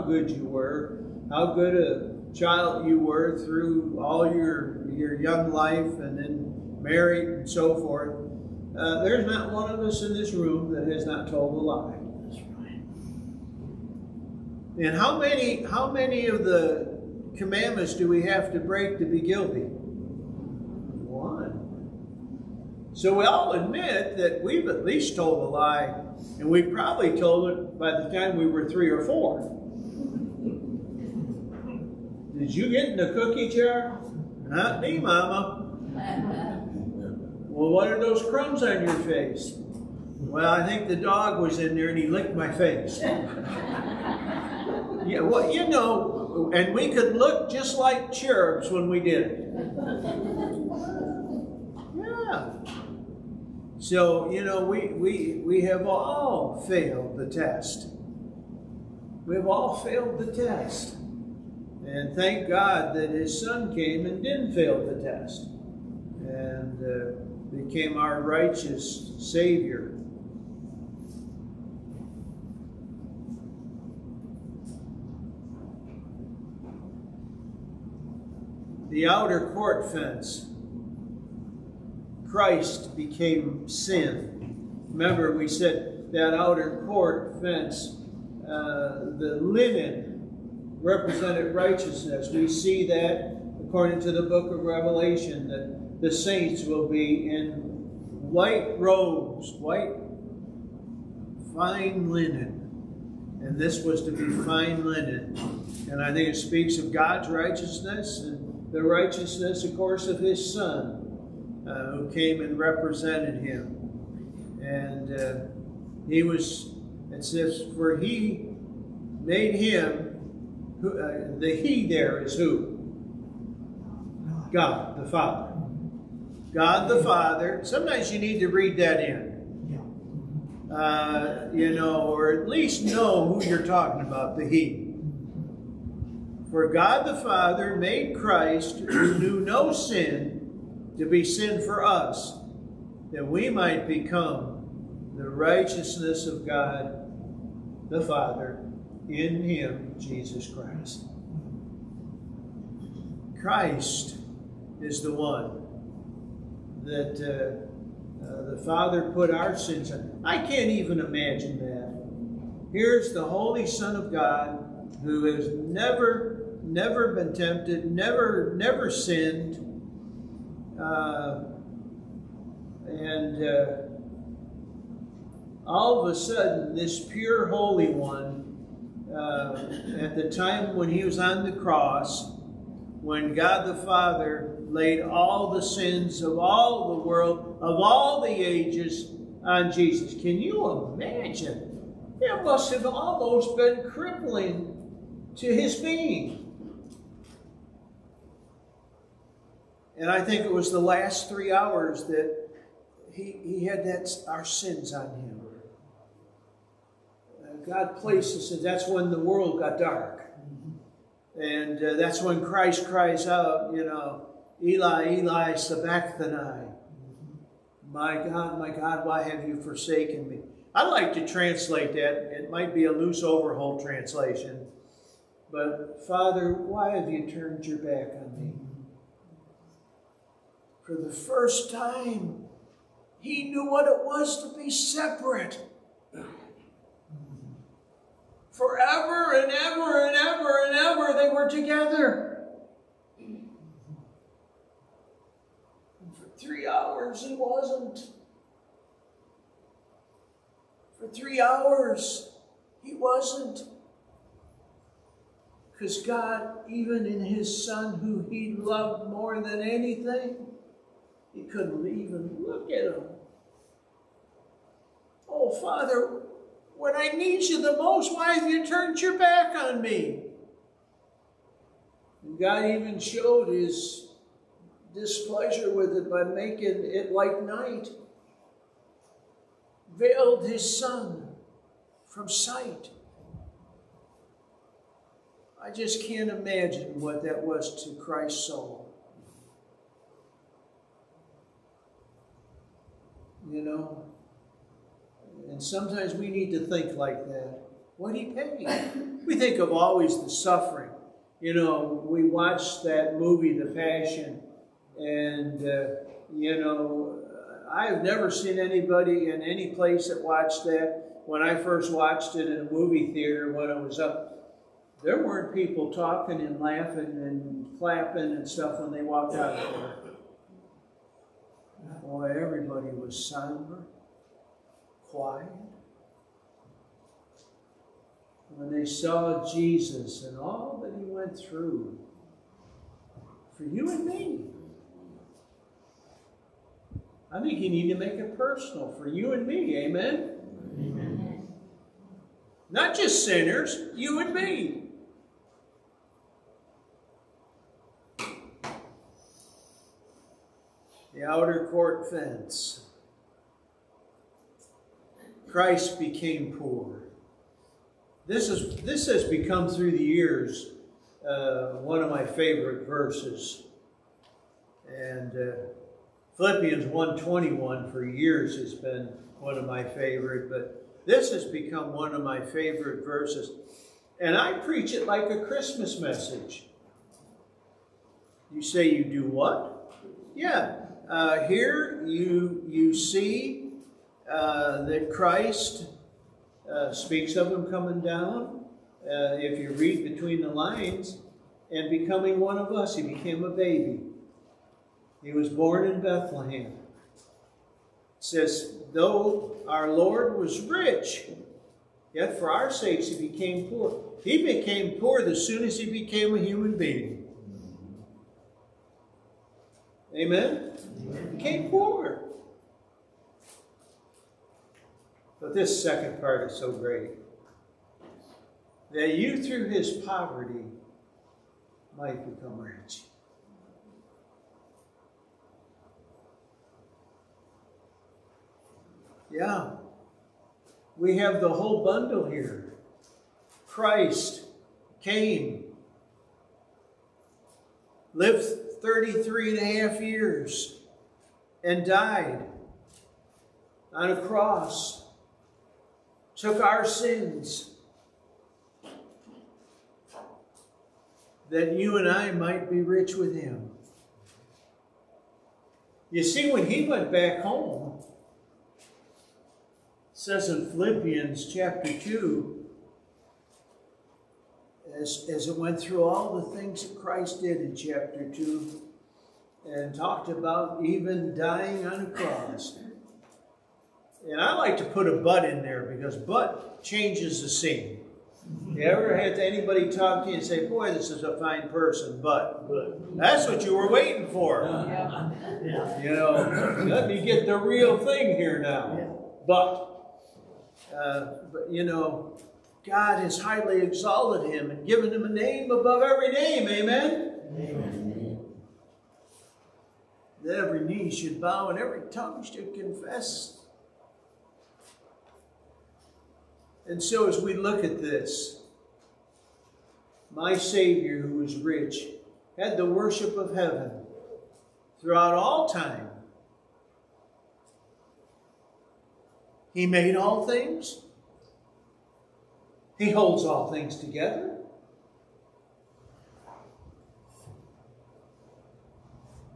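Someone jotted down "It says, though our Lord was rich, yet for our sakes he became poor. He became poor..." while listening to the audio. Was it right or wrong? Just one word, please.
right.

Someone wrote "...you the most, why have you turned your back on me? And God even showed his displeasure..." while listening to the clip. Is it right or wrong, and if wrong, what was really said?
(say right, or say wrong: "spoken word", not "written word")
right.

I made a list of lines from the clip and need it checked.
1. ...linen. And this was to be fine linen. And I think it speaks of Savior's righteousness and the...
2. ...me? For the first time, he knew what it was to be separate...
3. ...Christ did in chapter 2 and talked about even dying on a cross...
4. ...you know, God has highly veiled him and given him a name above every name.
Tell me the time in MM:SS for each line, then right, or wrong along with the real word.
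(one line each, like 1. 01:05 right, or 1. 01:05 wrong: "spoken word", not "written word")
1. 01:42 wrong: "God", not "Savior"
2. 03:48 right
3. 07:46 right
4. 08:11 wrong: "exalted", not "veiled".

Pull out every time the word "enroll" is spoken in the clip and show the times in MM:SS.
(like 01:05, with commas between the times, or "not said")
not said.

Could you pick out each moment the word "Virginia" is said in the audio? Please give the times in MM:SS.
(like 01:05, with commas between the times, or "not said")
not said.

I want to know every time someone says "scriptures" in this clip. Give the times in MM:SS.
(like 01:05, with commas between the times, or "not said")
not said.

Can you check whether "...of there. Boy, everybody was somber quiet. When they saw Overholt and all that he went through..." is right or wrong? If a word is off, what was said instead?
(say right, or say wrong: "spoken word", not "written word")
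wrong: "Jesus", not "Overholt".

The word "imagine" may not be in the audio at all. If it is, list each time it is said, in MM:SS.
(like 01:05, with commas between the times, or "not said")
02:41, 03:10, 04:46.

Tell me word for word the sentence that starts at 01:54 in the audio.
And uh, he was, it says, for he made him who, uh, the He there is who?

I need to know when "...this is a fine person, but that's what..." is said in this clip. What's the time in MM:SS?
08:00.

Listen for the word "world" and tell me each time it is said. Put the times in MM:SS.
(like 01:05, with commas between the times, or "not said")
03:07, 03:29.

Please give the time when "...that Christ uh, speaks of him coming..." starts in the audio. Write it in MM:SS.
06:24.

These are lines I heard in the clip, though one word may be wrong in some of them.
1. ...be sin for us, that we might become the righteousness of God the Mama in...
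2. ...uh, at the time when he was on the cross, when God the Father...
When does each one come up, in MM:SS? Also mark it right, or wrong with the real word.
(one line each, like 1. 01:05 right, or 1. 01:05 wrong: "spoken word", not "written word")
1. 02:21 wrong: "Father", not "Mama"
2. 02:59 right.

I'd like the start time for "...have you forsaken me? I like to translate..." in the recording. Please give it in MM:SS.
03:39.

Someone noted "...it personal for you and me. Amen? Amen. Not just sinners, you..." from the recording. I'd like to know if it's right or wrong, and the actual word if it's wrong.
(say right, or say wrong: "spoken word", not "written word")
right.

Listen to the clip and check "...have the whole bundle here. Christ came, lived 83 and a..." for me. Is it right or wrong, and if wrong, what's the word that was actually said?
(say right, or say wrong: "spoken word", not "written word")
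wrong: "33", not "83".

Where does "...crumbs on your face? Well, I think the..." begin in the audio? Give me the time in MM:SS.
00:38.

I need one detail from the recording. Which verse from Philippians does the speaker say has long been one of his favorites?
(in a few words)
Philippians 1:21.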